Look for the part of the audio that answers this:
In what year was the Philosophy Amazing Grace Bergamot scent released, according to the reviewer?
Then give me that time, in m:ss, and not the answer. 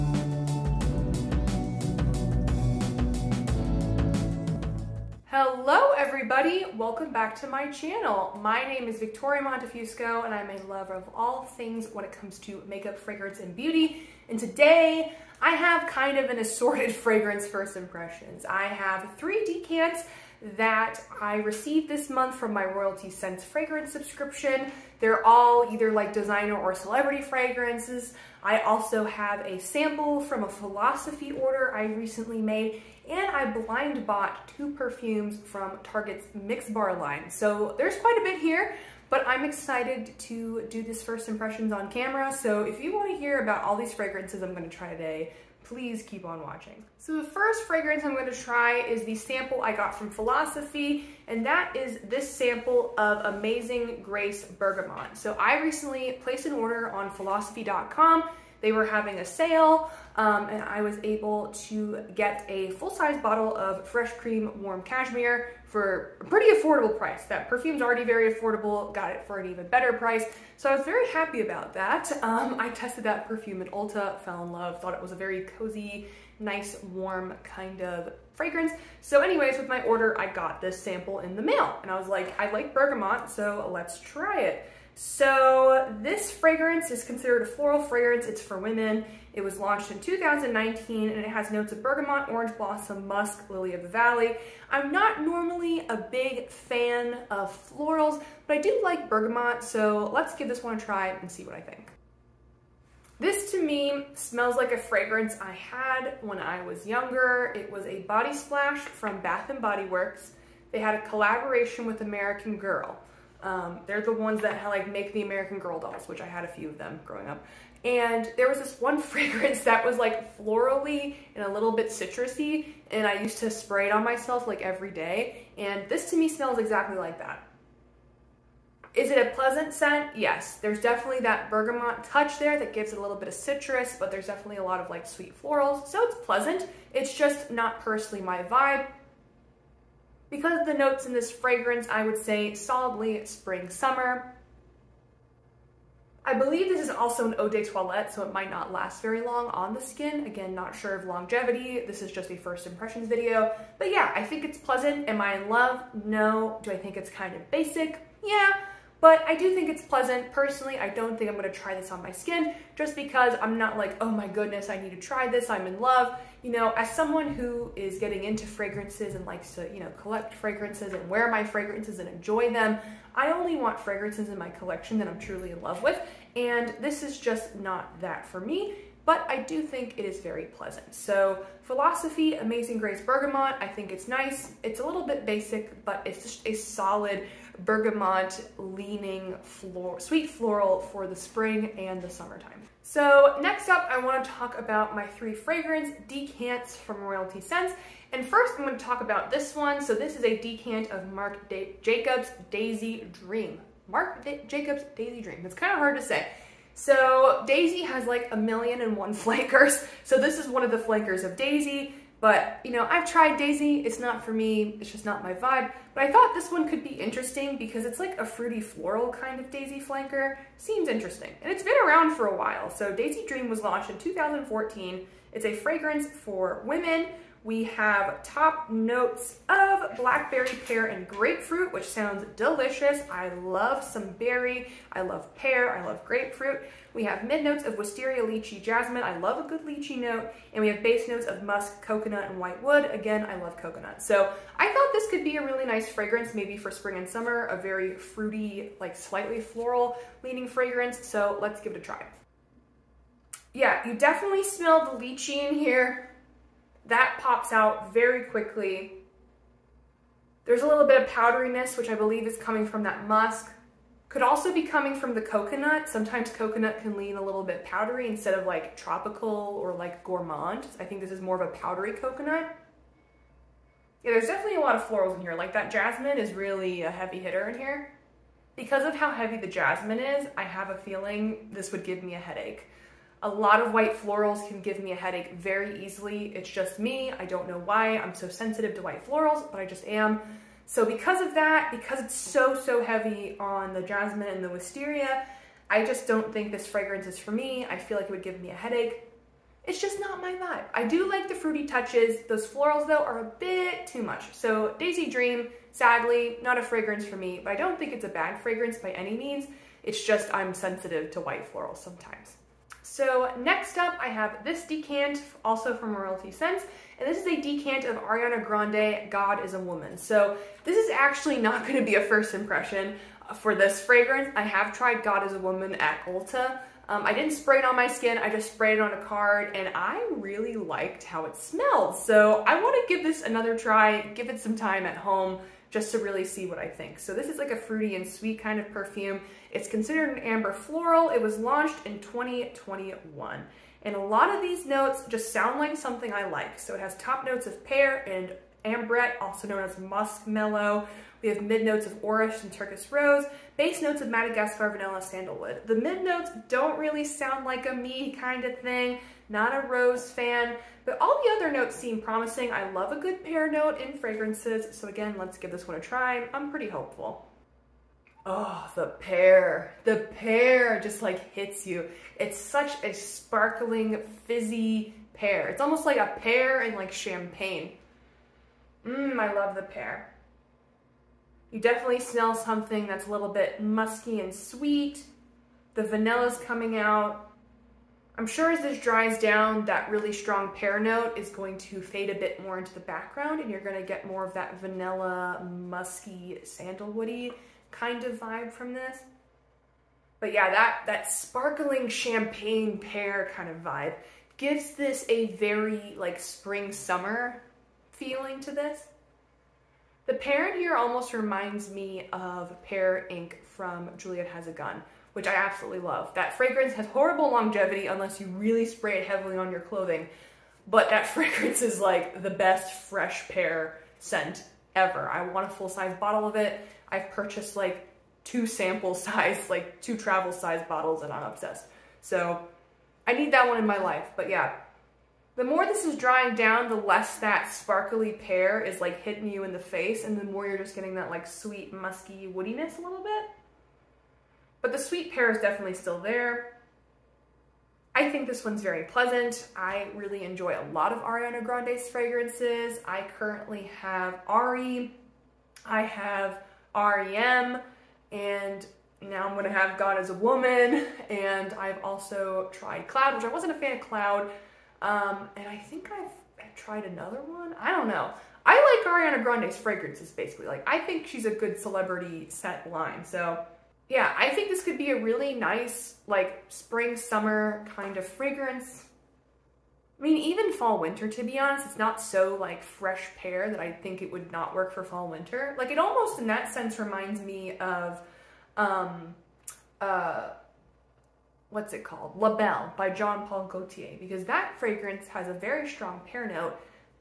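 1:29.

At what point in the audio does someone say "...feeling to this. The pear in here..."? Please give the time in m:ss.
6:47.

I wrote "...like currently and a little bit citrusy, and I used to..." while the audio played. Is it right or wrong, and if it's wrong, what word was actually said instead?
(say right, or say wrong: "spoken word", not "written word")
wrong: "florally", not "currently".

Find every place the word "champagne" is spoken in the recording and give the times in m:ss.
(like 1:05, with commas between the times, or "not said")
6:16, 6:41.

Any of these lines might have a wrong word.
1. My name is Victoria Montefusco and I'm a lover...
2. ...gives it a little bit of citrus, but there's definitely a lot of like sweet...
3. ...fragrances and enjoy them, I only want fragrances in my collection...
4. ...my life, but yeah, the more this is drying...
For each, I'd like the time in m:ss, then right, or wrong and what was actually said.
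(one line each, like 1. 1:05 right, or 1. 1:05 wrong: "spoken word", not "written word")
1. 0:08 right
2. 2:12 right
3. 2:51 right
4. 7:13 right.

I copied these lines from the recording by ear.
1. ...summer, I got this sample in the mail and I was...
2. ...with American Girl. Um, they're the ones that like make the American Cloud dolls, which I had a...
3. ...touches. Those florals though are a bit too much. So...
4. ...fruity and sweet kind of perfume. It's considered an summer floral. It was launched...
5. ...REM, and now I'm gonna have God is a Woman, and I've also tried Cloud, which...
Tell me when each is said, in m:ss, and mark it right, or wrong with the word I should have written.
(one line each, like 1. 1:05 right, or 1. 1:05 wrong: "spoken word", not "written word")
1. 1:19 wrong: "order", not "summer"
2. 1:51 wrong: "Girl", not "Cloud"
3. 5:01 right
4. 5:37 wrong: "amber", not "summer"
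5. 7:36 right.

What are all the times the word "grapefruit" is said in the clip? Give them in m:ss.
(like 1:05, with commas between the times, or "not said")
3:51, 3:56.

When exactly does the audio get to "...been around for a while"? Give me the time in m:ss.
3:41.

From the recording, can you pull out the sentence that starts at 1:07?
That perfume's already very affordable, got it for an even better price.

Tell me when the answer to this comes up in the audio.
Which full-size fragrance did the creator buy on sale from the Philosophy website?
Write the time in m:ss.
1:03.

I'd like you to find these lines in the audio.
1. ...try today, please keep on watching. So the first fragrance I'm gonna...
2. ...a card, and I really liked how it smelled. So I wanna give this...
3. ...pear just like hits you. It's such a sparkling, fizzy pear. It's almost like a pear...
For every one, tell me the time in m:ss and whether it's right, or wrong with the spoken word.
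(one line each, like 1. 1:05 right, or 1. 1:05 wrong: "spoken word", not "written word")
1. 0:44 right
2. 5:28 right
3. 6:10 right.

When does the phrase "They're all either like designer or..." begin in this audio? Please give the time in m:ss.
0:24.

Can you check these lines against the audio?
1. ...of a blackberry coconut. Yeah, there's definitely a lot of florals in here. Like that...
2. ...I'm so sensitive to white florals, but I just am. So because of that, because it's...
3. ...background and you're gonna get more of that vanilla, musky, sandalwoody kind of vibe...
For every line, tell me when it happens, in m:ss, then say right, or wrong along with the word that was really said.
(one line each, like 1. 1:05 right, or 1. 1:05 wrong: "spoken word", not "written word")
1. 4:31 wrong: "powdery", not "blackberry"
2. 4:47 right
3. 6:32 right.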